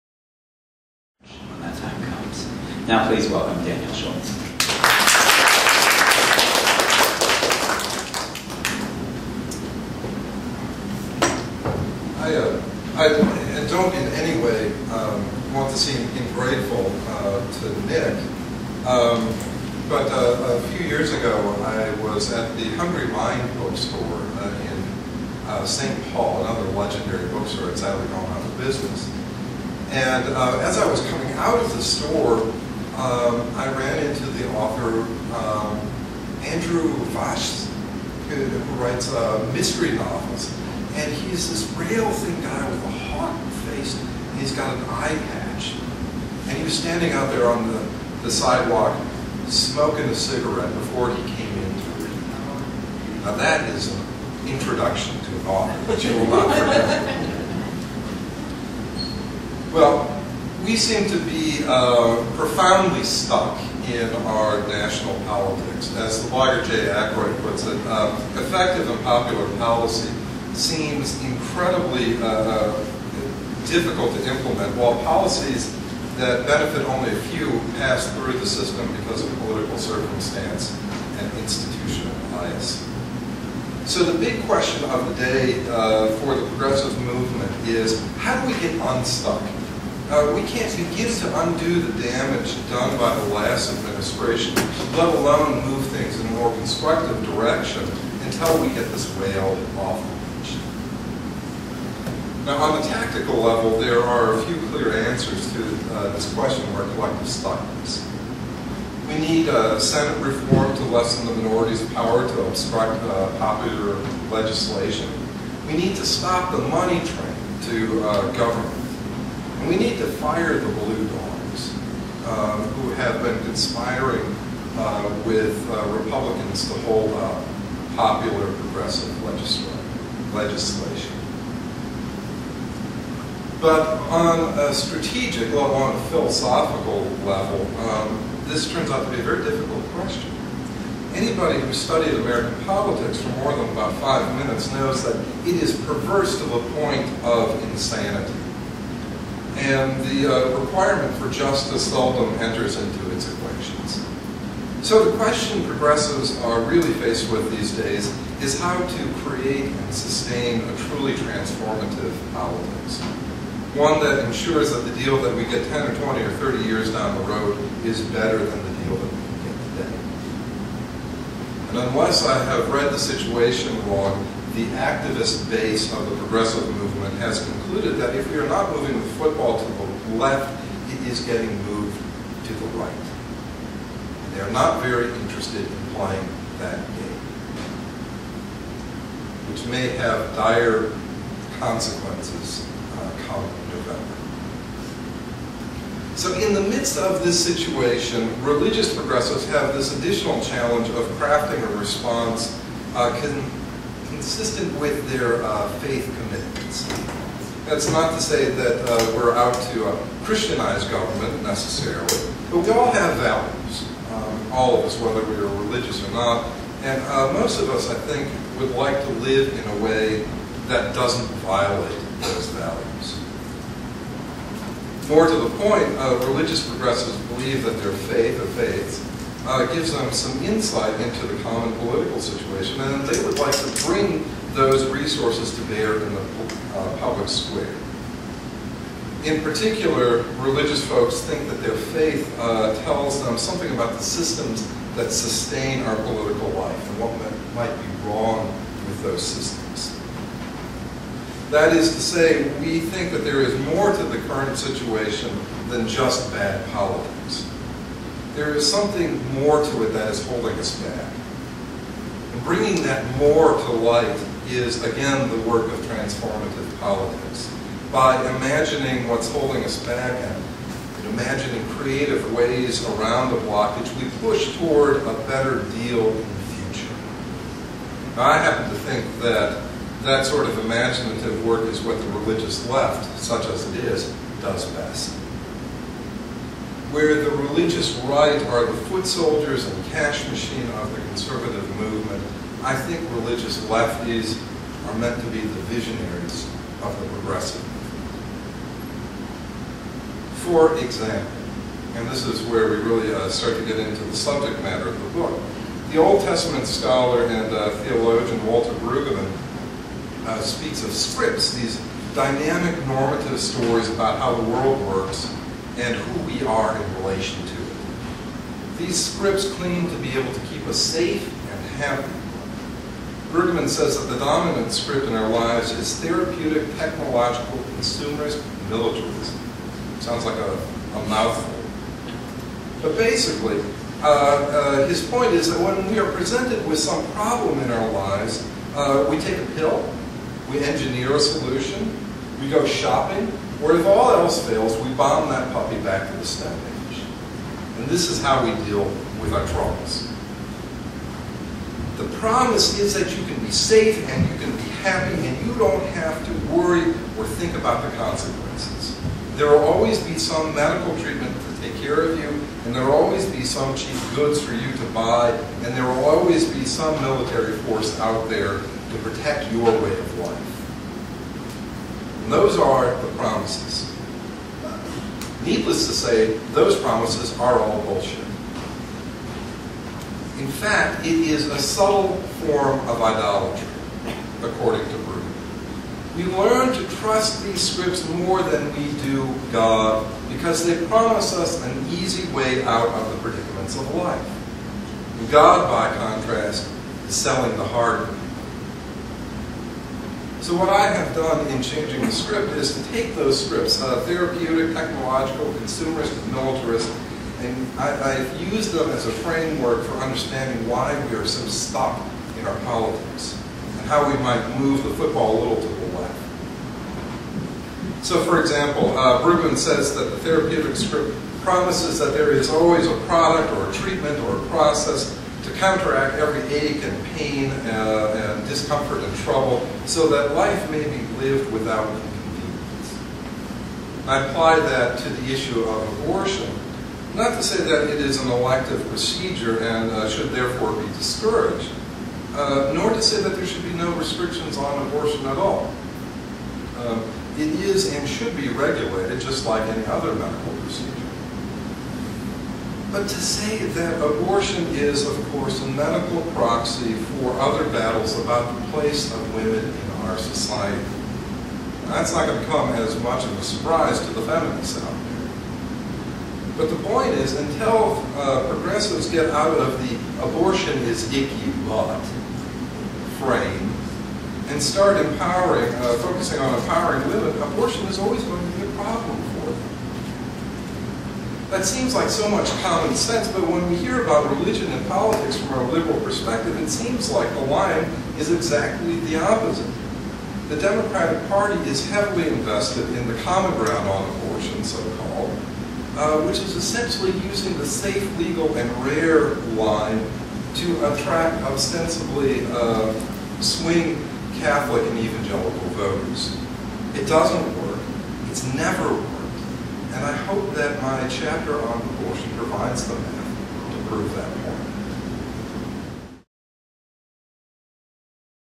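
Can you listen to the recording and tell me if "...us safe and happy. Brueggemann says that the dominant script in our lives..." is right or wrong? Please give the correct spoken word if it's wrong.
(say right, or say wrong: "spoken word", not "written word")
right.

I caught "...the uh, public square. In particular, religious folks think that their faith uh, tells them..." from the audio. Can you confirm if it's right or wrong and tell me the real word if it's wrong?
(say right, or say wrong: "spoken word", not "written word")
right.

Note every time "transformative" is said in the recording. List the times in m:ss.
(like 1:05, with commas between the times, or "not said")
2:41, 4:25.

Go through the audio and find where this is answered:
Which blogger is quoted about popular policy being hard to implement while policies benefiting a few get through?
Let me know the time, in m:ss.
1:06.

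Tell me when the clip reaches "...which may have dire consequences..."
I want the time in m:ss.
3:09.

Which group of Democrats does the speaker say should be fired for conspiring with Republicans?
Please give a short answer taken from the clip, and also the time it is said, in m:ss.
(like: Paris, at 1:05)
blue dogs, at 2:00.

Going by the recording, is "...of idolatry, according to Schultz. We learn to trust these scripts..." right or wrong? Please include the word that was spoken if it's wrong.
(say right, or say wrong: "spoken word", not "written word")
wrong: "Brueggemann", not "Schultz".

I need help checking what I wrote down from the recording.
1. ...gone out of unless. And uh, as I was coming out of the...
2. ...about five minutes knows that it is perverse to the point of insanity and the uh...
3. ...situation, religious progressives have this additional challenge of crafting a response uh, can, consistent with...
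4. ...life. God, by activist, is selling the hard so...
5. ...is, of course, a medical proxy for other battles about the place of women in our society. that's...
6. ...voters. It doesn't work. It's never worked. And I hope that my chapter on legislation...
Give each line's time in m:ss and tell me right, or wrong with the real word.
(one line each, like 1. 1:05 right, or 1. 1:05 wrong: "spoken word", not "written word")
1. 0:28 wrong: "business", not "unless"
2. 2:23 right
3. 3:17 right
4. 6:33 wrong: "contrast", not "activist"
5. 7:34 right
6. 8:25 wrong: "abortion", not "legislation".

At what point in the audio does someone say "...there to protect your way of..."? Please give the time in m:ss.
6:08.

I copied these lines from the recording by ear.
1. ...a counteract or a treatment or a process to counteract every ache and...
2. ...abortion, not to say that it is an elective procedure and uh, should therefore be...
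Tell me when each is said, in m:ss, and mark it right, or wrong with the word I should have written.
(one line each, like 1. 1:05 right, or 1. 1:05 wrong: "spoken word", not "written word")
1. 7:02 wrong: "product", not "counteract"
2. 7:16 right.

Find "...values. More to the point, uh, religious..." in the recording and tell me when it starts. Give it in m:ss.
3:42.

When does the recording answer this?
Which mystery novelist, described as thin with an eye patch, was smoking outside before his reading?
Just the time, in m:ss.
0:36.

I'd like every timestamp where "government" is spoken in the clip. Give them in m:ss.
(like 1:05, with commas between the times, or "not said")
1:58, 3:30.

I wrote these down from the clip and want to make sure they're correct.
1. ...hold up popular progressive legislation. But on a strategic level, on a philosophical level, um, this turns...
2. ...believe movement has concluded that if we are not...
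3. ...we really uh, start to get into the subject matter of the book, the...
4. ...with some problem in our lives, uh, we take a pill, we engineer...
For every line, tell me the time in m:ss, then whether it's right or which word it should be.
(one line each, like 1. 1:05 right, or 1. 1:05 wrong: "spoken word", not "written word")
1. 2:06 right
2. 2:56 wrong: "progressive", not "believe"
3. 5:02 right
4. 5:36 right.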